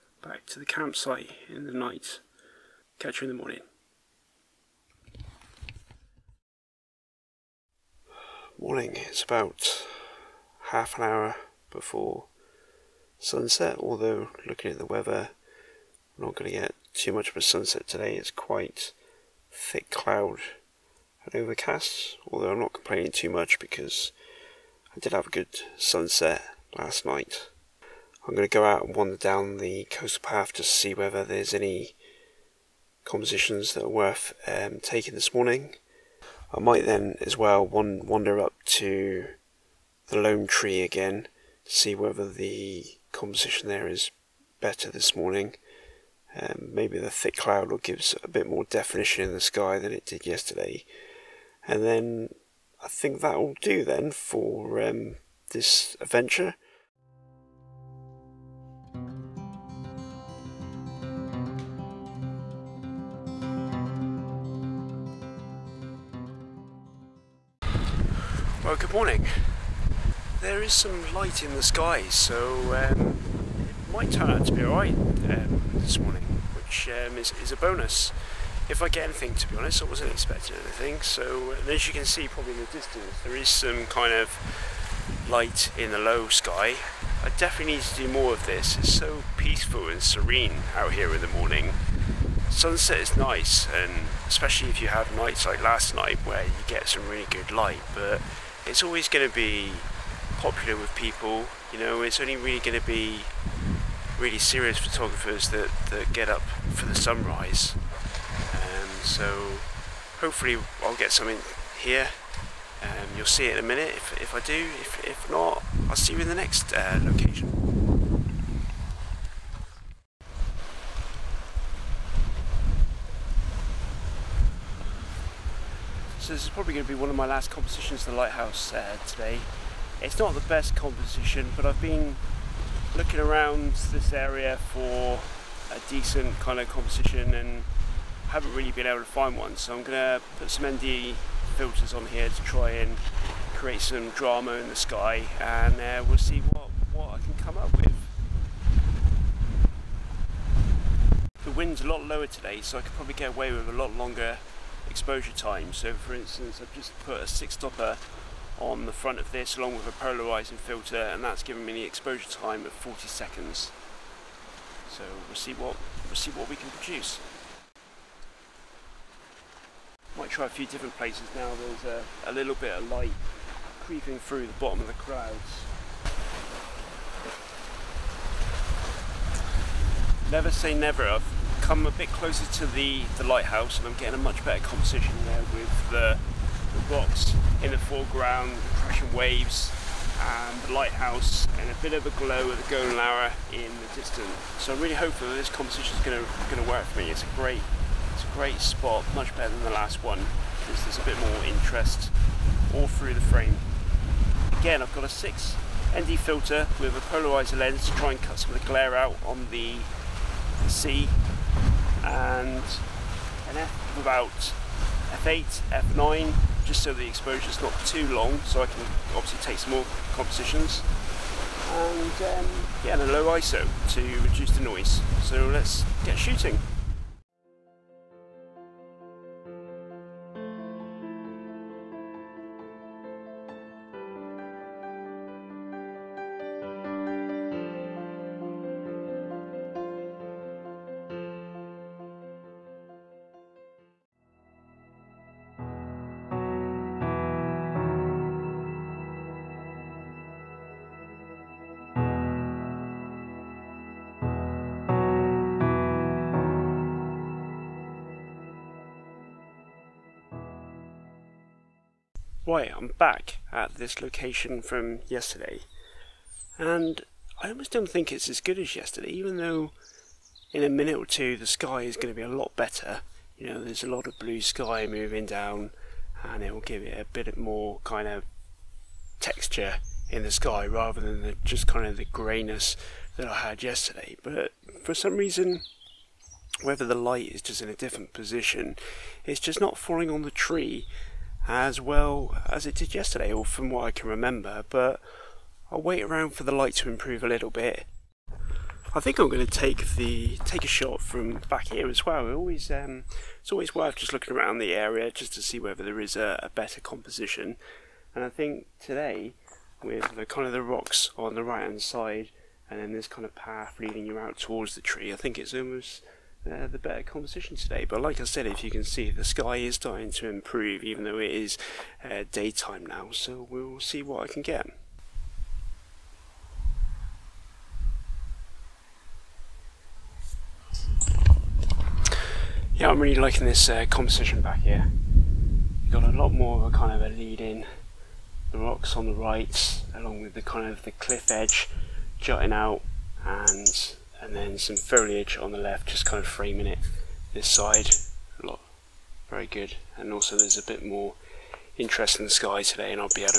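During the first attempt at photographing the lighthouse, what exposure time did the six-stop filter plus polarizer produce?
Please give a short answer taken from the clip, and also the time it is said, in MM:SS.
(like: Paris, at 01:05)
40 seconds, at 02:42.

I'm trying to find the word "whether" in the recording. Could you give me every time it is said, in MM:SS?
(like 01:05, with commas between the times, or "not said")
00:30, 00:41, 04:46, 05:05.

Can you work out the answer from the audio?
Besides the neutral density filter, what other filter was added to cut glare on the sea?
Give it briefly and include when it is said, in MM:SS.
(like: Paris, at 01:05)
polarizing filter, at 02:39.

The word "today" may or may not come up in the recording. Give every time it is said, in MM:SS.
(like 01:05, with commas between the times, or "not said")
00:17, 02:09, 02:32, 05:08, 05:17, 05:52.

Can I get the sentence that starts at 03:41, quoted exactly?
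And um, yeah, and a low ISO to reduce the noise.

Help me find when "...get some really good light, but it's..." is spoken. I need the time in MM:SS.
01:36.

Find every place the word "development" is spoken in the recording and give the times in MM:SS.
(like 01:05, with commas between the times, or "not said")
not said.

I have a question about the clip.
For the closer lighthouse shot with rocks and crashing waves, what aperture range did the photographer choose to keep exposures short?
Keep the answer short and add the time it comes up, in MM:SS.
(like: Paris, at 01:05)
F8, F9, at 03:35.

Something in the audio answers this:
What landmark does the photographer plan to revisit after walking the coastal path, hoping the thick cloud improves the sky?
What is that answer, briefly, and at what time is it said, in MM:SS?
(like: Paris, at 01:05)
the lone tree, at 00:40.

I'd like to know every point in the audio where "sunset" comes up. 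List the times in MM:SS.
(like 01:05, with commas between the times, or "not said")
00:13, 00:17, 00:25, 01:32.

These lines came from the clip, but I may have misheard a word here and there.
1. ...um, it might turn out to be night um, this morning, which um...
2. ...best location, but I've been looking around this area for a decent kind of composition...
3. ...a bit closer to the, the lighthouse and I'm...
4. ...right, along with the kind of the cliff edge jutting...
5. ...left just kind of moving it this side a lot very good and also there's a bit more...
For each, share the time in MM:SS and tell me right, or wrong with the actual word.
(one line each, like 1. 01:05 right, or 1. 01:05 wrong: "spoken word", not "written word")
1. 01:12 wrong: "alright", not "night"
2. 02:10 wrong: "composition", not "location"
3. 03:01 right
4. 05:39 right
5. 05:45 wrong: "framing", not "moving".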